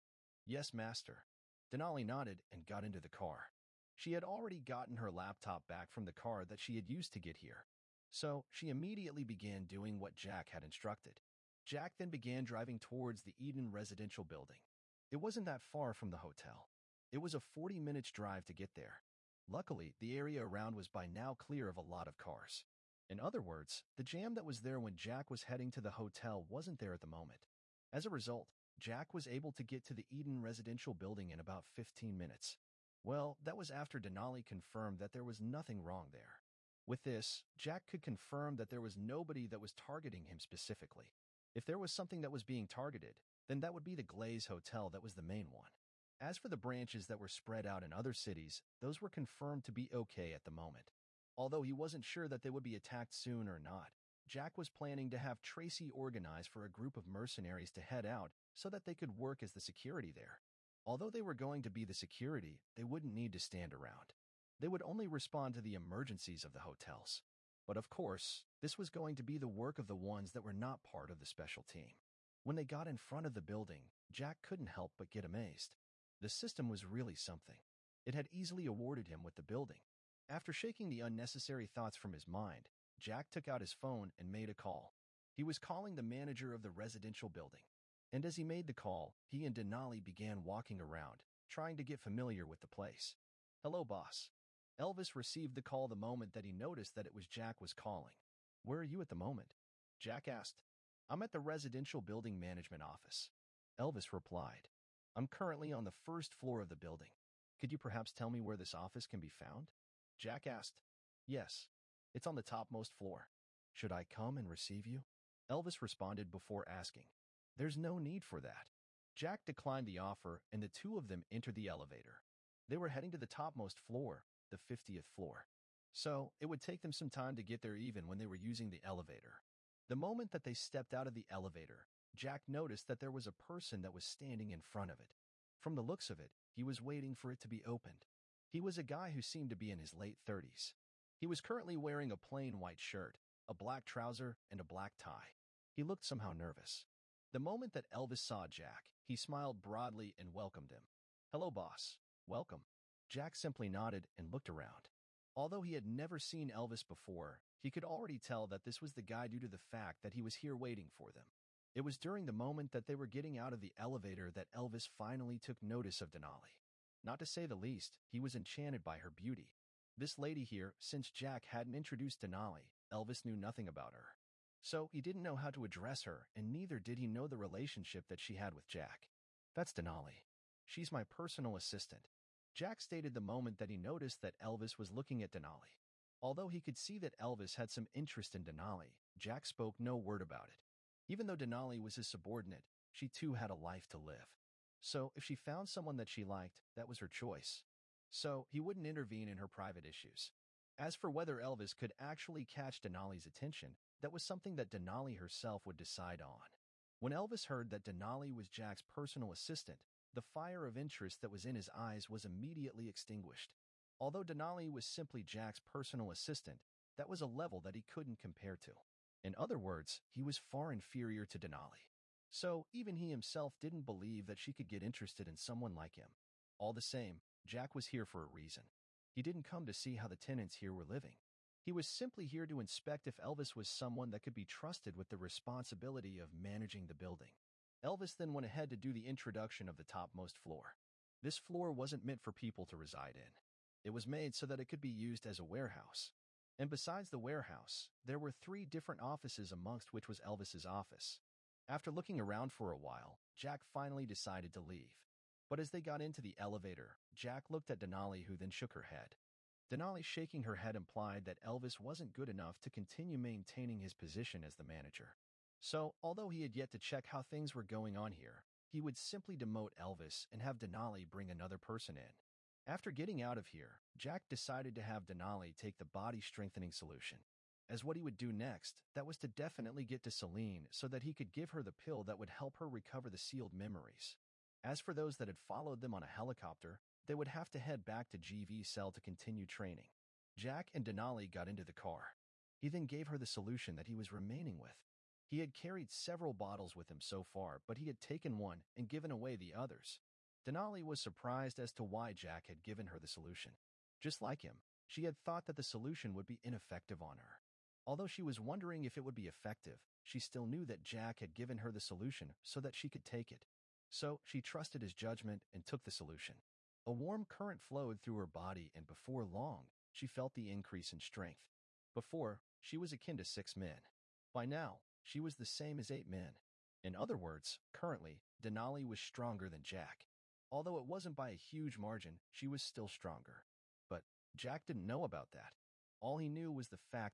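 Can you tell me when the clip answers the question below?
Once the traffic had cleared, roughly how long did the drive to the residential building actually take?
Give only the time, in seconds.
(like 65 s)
31 s.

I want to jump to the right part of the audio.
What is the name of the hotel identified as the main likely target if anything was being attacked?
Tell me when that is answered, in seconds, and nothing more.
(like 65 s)
44 s.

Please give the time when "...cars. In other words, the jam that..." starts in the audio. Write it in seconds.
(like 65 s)
22 s.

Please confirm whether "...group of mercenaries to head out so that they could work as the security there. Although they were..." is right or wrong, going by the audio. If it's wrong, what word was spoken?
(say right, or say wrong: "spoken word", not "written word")
right.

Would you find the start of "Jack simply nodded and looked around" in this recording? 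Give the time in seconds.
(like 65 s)
153 s.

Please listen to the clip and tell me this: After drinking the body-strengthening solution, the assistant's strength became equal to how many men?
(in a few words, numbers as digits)
8.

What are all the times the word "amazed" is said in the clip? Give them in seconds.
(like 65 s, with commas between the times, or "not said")
75 s.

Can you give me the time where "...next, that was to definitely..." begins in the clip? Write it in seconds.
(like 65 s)
278 s.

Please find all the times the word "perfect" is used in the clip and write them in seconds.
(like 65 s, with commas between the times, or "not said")
not said.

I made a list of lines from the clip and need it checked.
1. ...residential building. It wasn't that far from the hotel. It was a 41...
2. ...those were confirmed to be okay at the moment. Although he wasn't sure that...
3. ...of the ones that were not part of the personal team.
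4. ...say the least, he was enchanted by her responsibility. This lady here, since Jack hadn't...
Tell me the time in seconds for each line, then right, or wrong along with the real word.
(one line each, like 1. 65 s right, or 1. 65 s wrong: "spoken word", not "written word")
1. 13 s wrong: "40", not "41"
2. 48 s right
3. 69 s wrong: "special", not "personal"
4. 167 s wrong: "beauty", not "responsibility".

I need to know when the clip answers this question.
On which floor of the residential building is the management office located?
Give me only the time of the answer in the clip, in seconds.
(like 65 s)
124 s.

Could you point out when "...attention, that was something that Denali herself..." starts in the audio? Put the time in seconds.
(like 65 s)
203 s.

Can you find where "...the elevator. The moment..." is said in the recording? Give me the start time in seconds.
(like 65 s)
128 s.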